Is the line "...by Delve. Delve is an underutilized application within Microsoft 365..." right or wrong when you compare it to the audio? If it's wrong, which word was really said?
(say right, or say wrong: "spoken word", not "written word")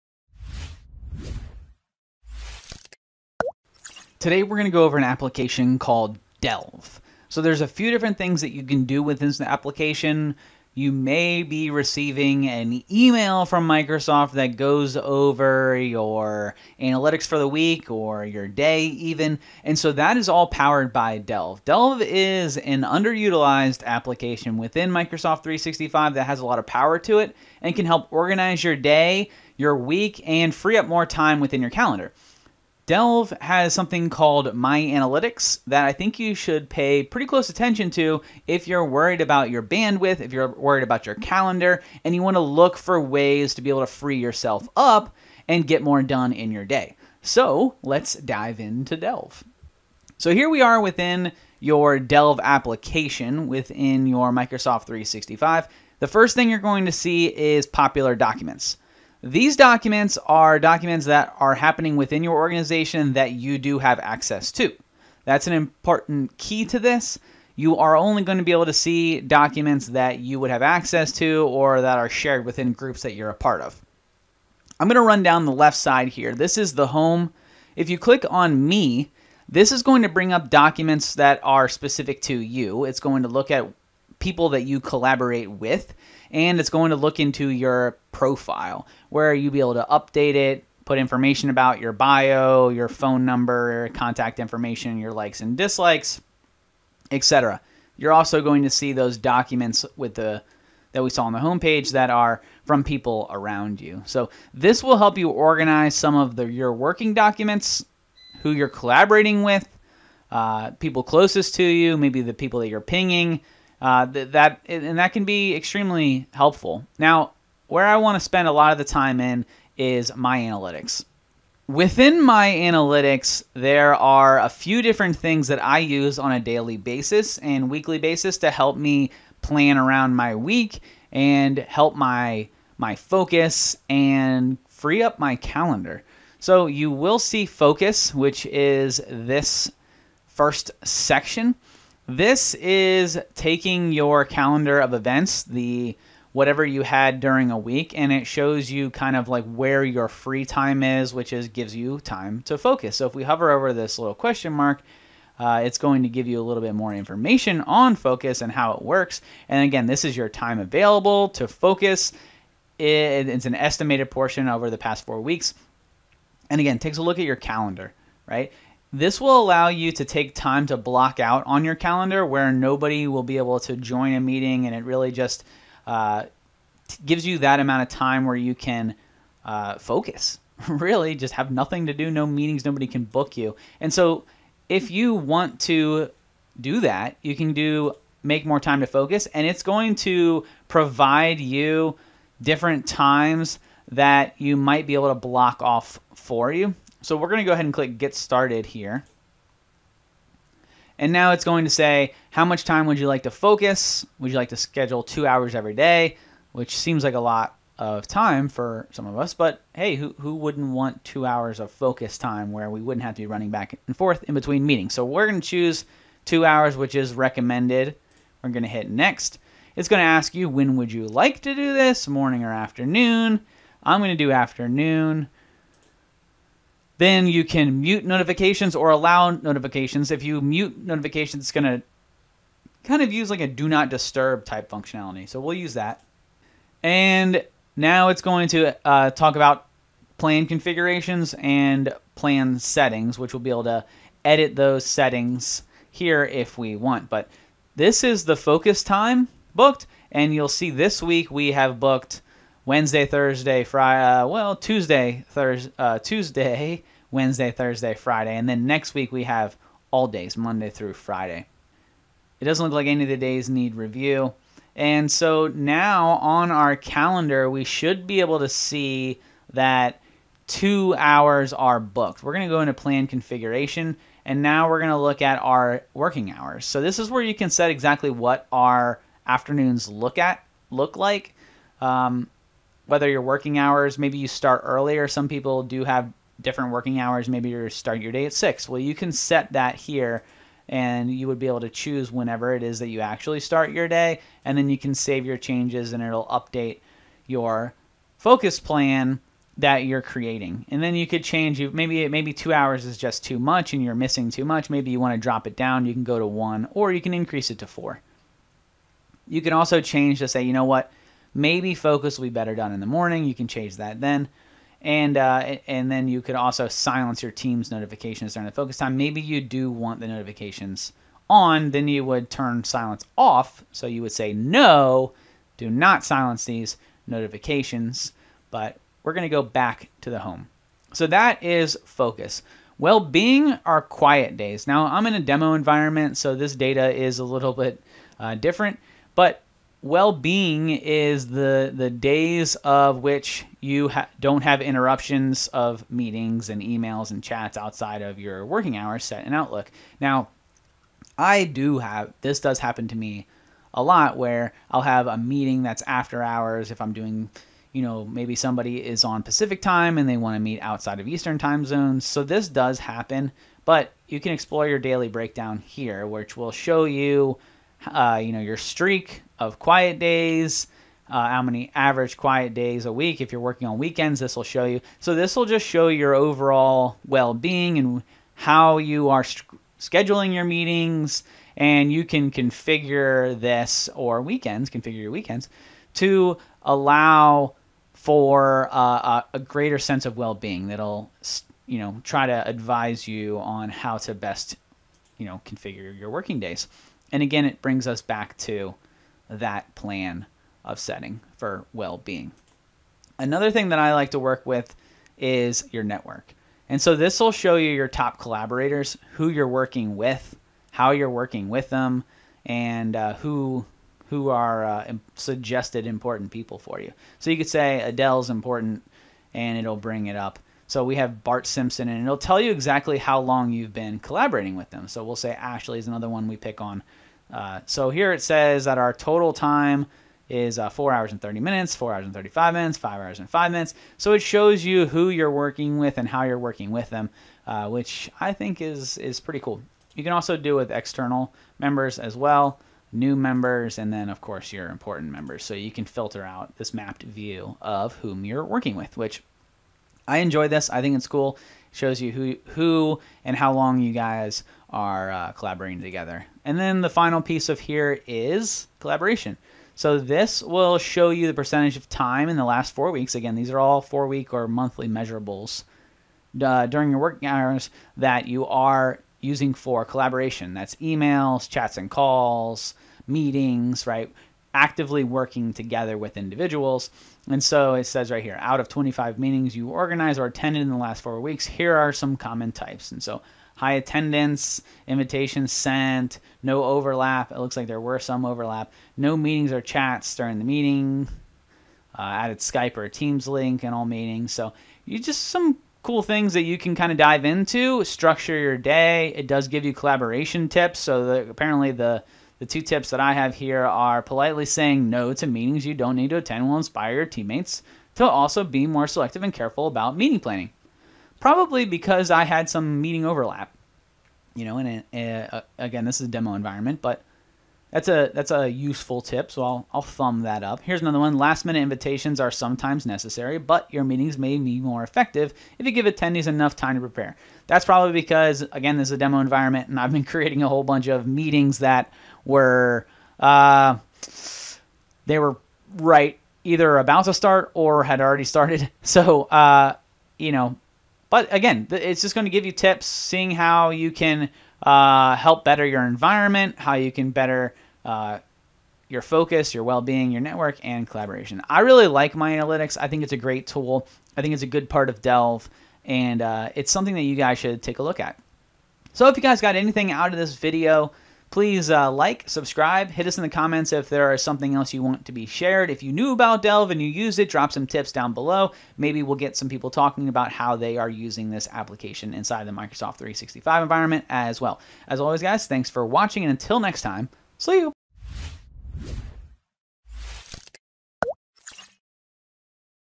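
right.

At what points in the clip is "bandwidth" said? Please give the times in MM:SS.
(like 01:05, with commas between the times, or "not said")
00:39.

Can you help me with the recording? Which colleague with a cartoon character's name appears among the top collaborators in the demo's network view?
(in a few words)
Bart Simpson.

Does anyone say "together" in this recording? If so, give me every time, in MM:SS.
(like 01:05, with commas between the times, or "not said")
07:35, 07:55.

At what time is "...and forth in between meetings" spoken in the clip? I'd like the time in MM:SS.
03:33.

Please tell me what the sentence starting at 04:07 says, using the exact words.
But this is the focus time booked.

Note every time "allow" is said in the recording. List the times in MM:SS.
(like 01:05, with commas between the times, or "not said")
02:49, 03:48, 06:26.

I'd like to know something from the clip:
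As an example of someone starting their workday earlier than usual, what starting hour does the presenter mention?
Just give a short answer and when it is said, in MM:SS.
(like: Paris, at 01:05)
6, at 04:48.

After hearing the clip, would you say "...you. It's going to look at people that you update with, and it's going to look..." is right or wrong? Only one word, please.
wrong.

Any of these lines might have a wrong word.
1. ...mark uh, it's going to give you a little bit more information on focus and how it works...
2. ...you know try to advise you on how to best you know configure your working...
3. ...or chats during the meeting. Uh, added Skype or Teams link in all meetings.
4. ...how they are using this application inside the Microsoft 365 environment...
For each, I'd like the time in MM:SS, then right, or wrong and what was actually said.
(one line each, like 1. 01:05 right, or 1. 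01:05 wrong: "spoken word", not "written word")
1. 02:34 right
2. 06:31 right
3. 08:09 right
4. 09:30 right.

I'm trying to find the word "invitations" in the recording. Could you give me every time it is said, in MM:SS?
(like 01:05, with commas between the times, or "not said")
08:04, 08:41.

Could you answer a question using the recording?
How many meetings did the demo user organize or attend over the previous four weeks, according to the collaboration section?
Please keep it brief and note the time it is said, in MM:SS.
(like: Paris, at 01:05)
25, at 07:58.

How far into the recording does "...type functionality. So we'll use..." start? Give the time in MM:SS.
03:54.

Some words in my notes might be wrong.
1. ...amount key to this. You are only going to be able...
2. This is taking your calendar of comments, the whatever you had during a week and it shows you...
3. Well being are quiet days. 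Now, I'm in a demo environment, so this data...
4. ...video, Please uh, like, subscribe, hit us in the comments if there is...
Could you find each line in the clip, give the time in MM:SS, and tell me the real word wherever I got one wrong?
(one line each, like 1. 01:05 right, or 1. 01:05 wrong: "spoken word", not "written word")
1. 01:05 wrong: "important", not "amount"
2. 02:22 wrong: "events", not "comments"
3. 05:32 right
4. 09:20 right.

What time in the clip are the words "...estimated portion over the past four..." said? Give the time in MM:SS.
02:43.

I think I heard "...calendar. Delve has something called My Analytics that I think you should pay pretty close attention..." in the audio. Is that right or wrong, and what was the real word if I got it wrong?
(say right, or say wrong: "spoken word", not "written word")
right.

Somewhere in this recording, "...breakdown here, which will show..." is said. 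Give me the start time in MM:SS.
06:05.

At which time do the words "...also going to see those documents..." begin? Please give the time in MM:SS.
01:38.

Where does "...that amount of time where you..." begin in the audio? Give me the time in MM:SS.
02:57.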